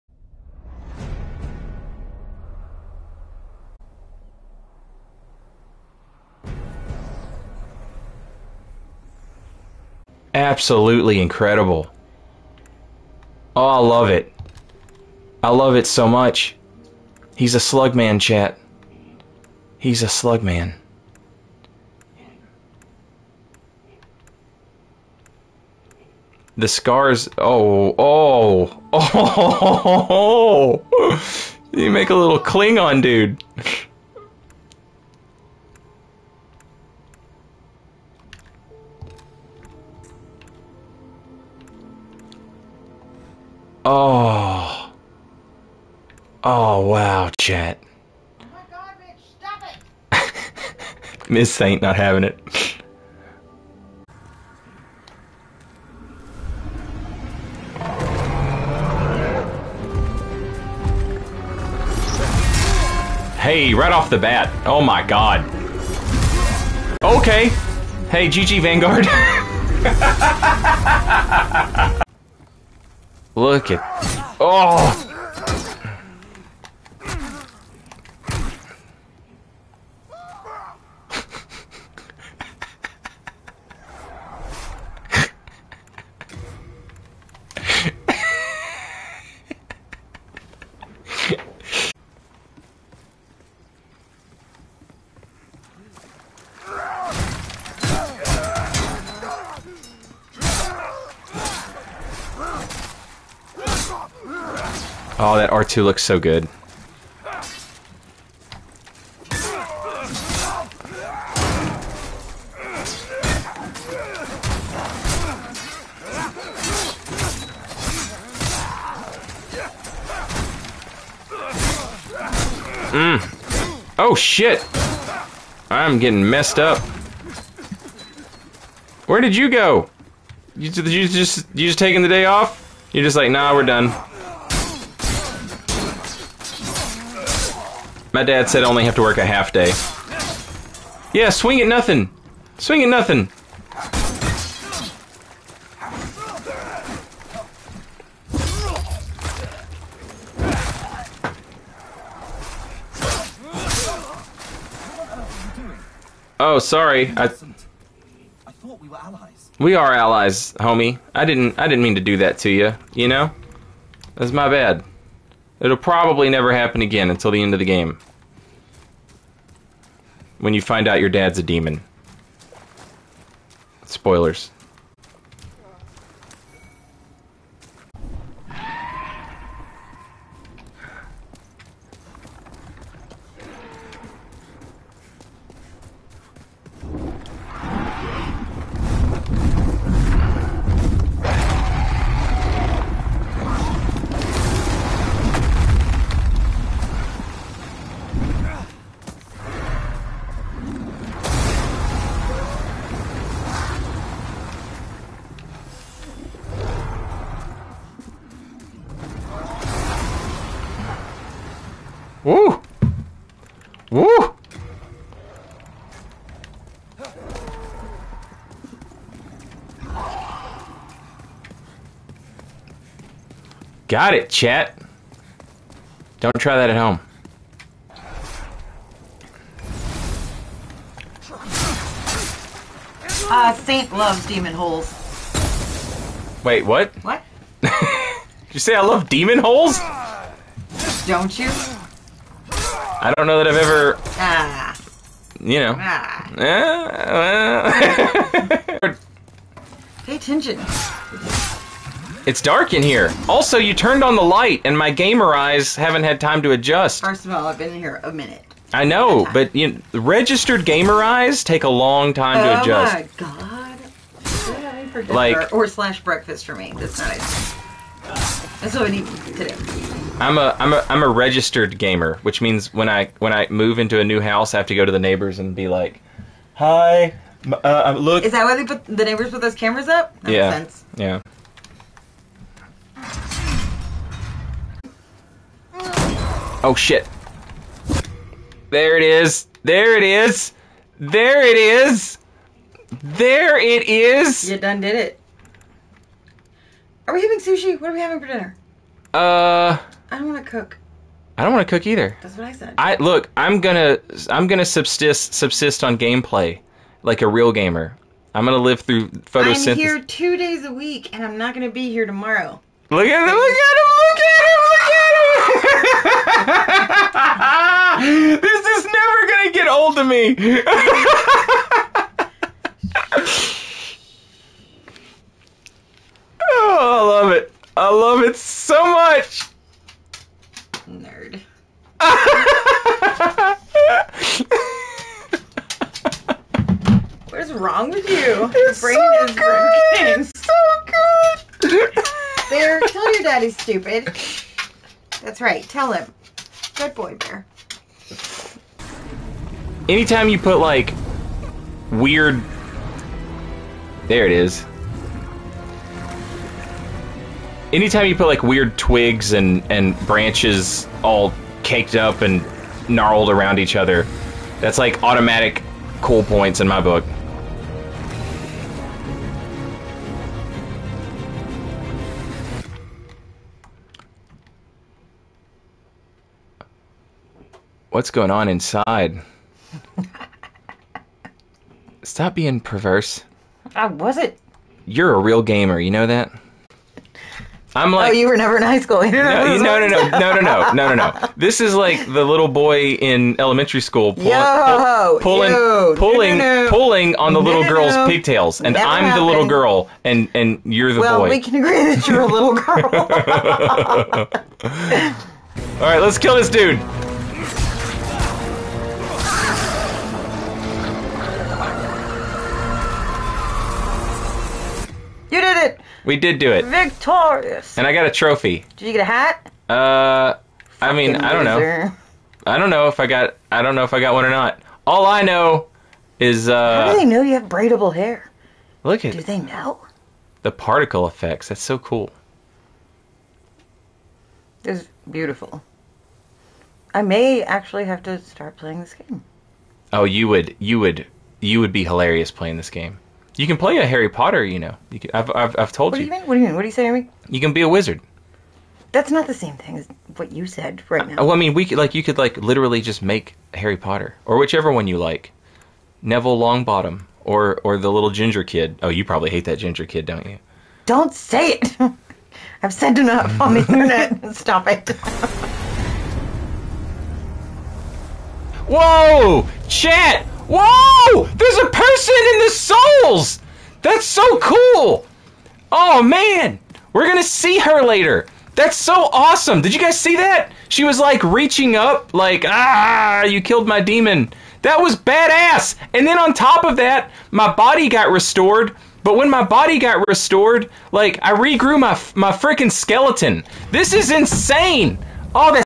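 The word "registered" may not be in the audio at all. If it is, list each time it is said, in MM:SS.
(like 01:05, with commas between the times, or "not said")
04:19, 04:31.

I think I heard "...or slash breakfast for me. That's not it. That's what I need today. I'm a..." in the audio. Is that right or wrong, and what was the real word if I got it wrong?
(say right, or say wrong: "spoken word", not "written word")
right.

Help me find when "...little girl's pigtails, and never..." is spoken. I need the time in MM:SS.
06:37.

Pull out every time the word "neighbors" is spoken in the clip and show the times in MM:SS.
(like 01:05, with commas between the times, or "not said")
04:34, 04:39.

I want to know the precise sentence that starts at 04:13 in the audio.
Also, you turned on the light, and my gamer eyes haven't had time to adjust.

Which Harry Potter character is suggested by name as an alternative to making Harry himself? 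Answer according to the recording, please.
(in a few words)
Neville Longbottom.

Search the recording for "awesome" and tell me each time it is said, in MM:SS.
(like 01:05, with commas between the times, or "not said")
07:59.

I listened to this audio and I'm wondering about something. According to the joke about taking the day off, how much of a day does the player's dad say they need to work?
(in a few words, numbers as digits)
half day.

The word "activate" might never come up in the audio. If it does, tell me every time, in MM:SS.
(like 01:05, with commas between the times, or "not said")
not said.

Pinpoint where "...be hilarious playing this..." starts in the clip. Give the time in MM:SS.
07:21.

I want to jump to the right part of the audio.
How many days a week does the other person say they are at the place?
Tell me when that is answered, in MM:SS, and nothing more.
05:10.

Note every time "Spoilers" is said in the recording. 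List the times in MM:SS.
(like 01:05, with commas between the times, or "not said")
02:53.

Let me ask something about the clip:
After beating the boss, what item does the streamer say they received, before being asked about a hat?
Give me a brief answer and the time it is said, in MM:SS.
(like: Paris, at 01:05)
trophy, at 06:58.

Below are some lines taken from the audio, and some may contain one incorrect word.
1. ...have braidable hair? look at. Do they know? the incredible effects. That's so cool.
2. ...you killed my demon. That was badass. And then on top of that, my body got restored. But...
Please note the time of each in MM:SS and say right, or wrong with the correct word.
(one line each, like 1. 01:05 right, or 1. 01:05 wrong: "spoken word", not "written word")
1. 07:07 wrong: "particle", not "incredible"
2. 08:03 right.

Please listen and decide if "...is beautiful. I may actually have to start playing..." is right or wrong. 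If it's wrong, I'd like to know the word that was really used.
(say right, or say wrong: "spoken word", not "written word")
right.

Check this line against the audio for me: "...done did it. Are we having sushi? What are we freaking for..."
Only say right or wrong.
wrong.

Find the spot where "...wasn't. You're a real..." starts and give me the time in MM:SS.
06:23.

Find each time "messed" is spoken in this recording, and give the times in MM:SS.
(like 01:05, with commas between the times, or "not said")
02:06.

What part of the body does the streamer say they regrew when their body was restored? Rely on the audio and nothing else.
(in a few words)
skeleton.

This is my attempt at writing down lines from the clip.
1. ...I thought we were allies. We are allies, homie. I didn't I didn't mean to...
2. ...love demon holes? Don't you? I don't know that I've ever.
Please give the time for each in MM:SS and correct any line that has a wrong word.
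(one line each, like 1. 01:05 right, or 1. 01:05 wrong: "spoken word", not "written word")
1. 02:37 right
2. 03:58 right.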